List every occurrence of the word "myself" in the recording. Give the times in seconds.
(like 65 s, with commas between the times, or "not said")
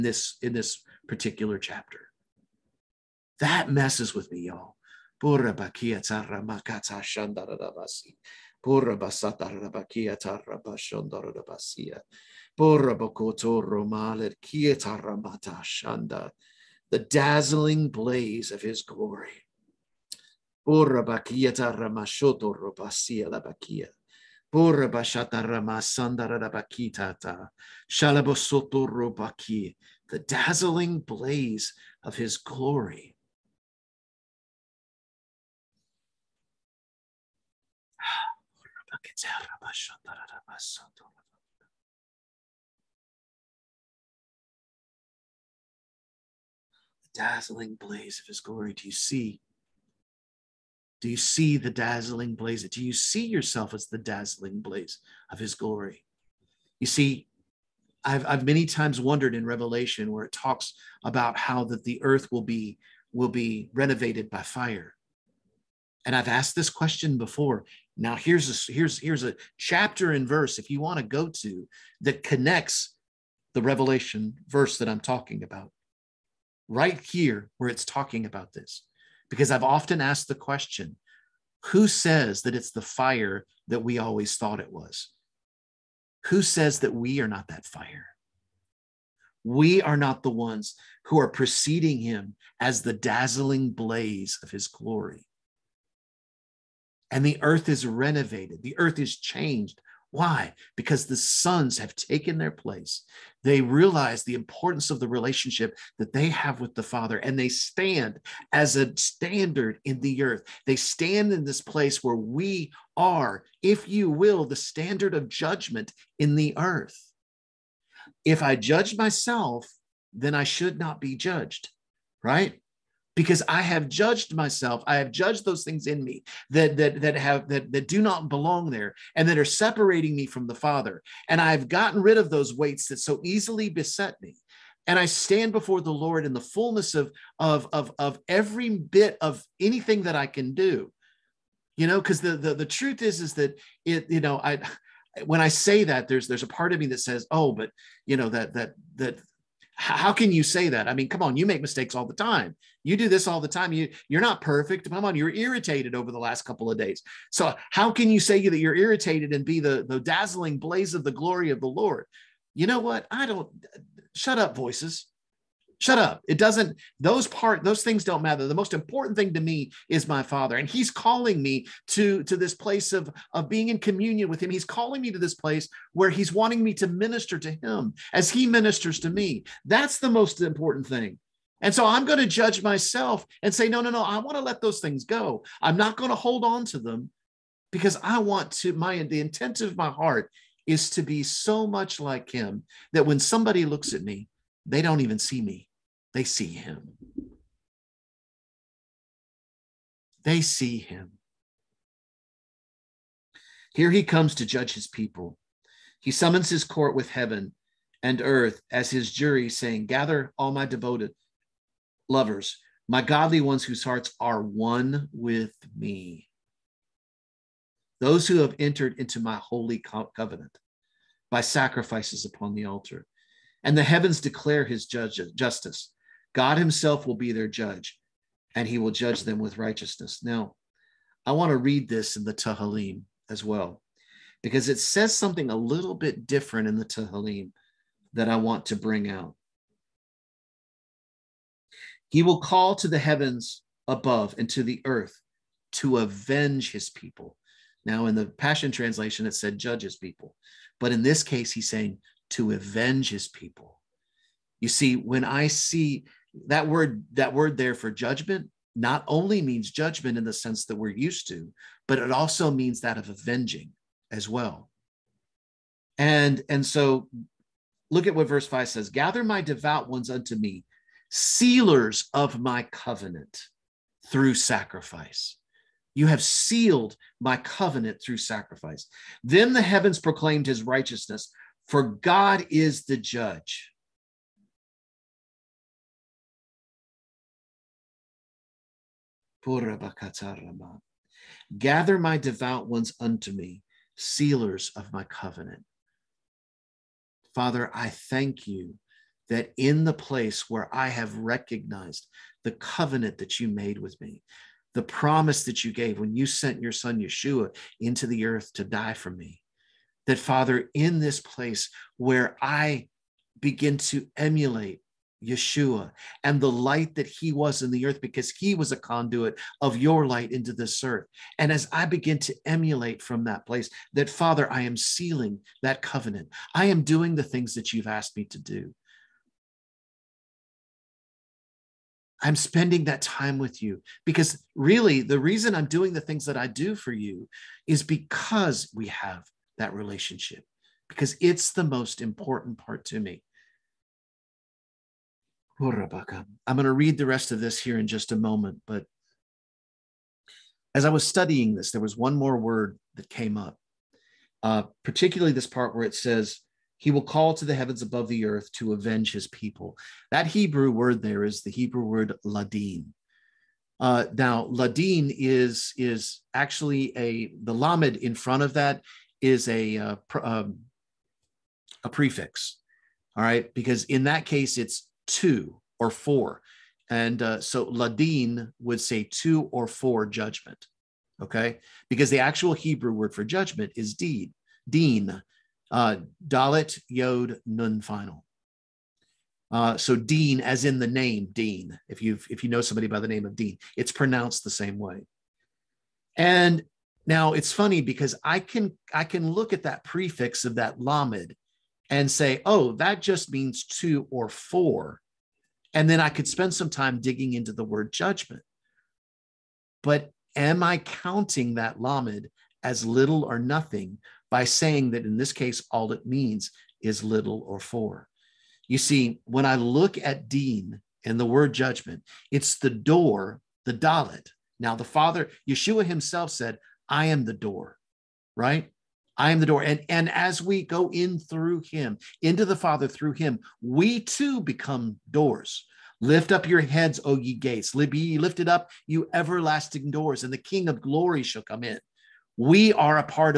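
118 s, 124 s, 182 s.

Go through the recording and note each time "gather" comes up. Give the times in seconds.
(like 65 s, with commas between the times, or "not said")
209 s, 268 s, 291 s.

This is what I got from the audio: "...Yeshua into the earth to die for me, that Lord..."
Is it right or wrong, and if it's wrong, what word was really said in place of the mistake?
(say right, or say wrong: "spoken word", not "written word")
wrong: "Father", not "Lord".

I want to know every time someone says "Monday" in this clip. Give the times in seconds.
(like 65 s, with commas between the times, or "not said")
not said.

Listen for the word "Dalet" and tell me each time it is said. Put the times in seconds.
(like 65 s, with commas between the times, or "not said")
386 s, 423 s.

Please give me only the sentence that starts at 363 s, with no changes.
Uh, now, ladin is is actually a the lamed in front of that is a uh, pr- um, a prefix.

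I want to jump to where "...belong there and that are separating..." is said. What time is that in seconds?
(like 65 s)
128 s.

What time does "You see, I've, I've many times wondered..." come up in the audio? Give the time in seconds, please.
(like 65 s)
56 s.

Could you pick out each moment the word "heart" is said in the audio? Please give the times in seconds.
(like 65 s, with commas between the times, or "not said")
189 s, 213 s.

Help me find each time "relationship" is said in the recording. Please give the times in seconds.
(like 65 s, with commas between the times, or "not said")
105 s, 339 s.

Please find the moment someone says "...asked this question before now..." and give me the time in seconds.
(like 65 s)
66 s.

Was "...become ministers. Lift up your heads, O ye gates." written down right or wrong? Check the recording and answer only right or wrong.
wrong.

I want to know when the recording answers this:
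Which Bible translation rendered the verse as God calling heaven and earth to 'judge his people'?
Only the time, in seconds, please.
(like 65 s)
248 s.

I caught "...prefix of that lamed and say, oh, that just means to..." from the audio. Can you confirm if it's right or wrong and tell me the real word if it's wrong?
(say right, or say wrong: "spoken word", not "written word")
right.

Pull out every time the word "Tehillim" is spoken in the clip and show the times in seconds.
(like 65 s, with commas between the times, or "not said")
232 s, 236 s.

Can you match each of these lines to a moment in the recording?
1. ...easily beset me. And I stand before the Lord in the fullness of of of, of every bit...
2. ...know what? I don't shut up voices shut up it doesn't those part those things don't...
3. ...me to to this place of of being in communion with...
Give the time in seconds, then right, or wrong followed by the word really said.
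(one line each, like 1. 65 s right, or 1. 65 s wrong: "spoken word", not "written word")
1. 133 s right
2. 162 s right
3. 171 s right.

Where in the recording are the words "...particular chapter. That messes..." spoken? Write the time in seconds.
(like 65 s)
1 s.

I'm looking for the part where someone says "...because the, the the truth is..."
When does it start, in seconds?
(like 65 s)
141 s.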